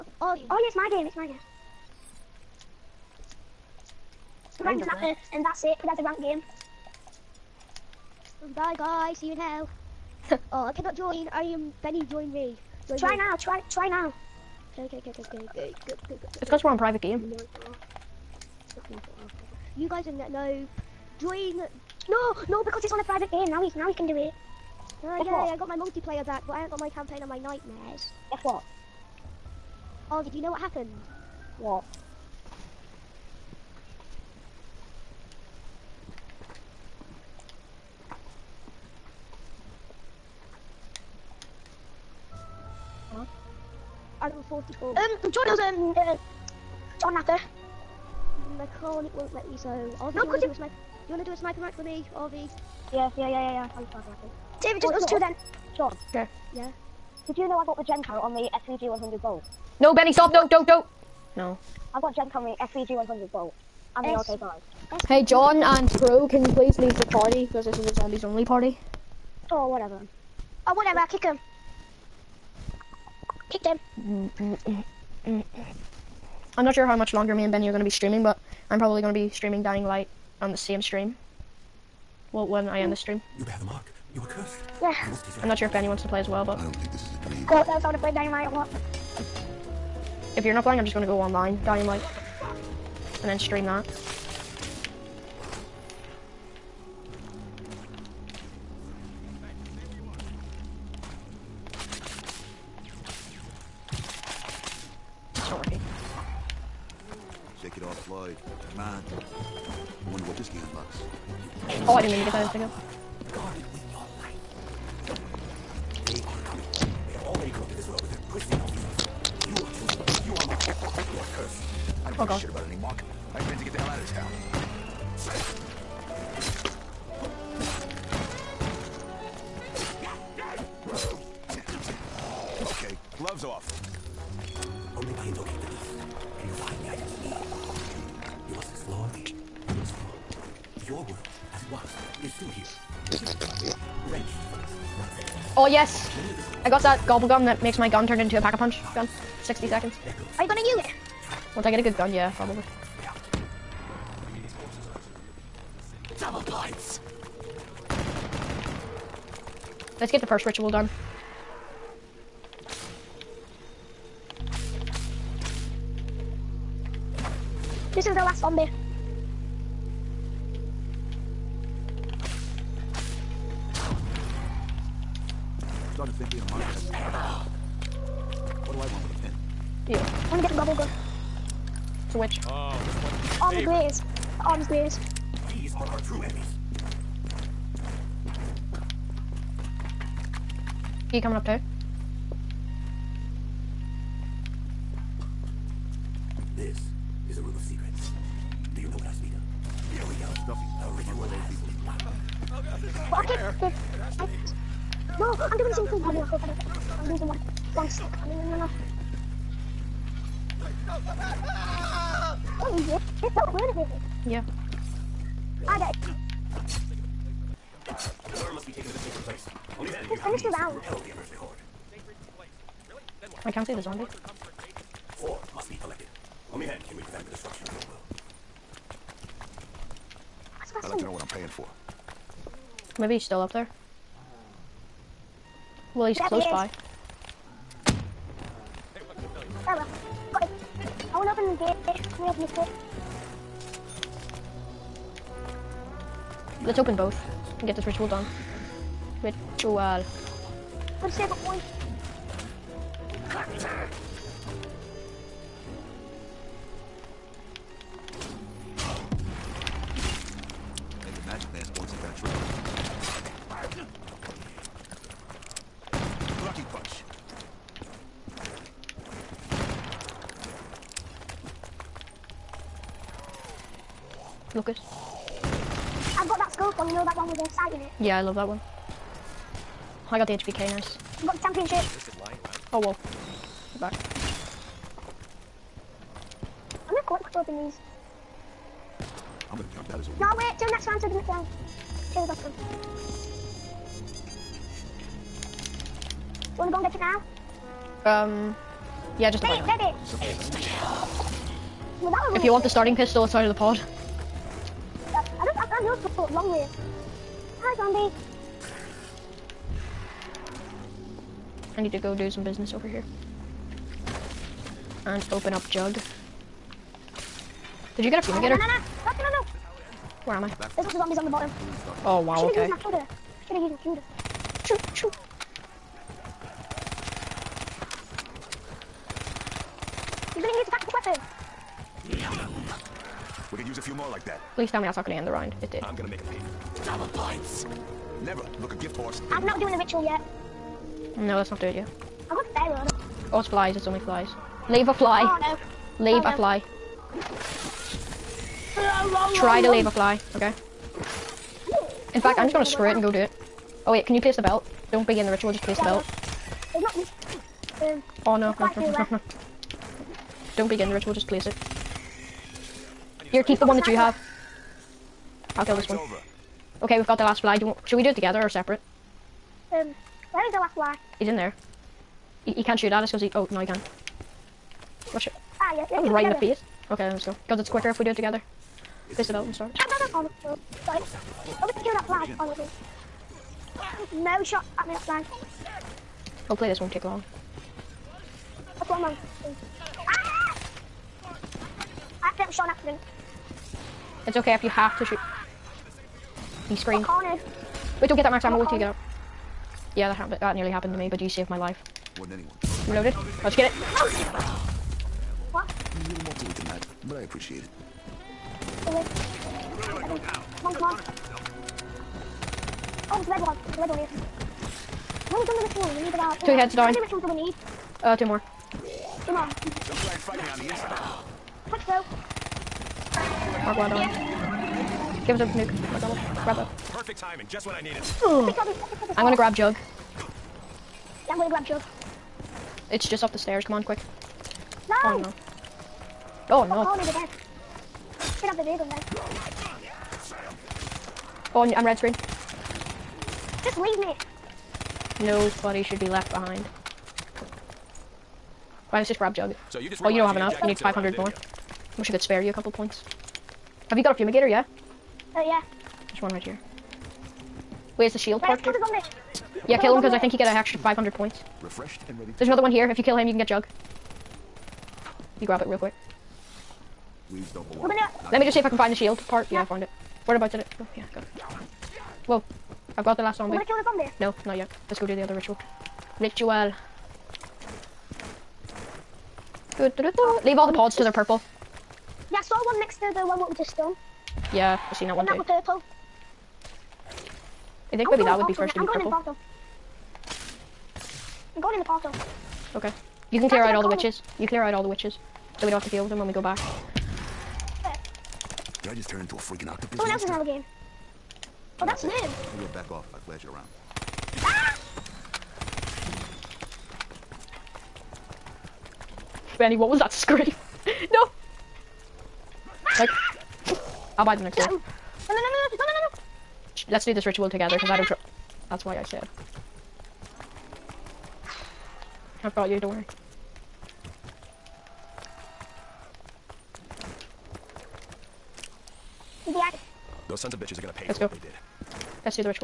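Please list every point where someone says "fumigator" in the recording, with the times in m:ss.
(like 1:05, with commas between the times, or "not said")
5:18, 7:34.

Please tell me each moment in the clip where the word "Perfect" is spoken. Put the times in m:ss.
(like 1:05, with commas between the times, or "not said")
7:06.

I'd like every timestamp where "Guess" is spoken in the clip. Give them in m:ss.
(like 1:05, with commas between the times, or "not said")
0:28.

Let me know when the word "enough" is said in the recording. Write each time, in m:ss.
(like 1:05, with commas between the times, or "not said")
7:30.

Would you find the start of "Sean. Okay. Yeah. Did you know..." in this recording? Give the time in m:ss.
0:55.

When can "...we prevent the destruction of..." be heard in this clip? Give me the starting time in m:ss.
3:46.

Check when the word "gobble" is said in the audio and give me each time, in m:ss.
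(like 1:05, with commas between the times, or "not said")
2:27.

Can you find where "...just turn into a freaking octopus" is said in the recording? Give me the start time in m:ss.
8:18.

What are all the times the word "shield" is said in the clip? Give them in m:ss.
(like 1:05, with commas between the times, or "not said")
7:38, 7:48.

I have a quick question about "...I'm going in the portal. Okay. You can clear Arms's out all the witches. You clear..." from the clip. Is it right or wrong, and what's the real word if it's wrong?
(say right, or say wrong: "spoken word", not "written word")
wrong: "That", not "Arms".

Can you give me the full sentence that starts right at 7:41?
Refreshed and ready There's another one here.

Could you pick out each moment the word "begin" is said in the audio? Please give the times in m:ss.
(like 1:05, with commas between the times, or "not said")
5:55, 6:00.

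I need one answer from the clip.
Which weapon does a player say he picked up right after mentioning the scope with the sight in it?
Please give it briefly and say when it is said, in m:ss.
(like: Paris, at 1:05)
HVK, at 4:40.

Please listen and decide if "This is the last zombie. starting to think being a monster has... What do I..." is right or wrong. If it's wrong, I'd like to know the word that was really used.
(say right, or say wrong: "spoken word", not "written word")
right.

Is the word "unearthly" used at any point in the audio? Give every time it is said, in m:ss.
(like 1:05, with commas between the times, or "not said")
3:41.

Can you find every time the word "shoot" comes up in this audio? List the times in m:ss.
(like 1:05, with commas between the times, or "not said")
6:12, 6:35.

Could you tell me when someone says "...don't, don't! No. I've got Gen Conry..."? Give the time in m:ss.
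1:00.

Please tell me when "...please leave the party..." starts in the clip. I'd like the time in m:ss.
1:06.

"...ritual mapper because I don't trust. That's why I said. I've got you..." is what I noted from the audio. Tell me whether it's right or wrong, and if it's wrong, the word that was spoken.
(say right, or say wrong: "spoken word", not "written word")
wrong: "together", not "mapper".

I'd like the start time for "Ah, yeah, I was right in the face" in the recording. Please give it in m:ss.
6:15.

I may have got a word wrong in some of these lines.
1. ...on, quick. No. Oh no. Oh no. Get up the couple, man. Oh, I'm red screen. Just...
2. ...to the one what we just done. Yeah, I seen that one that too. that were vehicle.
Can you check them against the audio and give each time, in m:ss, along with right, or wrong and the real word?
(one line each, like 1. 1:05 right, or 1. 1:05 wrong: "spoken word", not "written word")
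1. 7:13 wrong: "vehicle", not "couple"
2. 8:03 wrong: "purple", not "vehicle".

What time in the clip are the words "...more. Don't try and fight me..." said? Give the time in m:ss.
6:59.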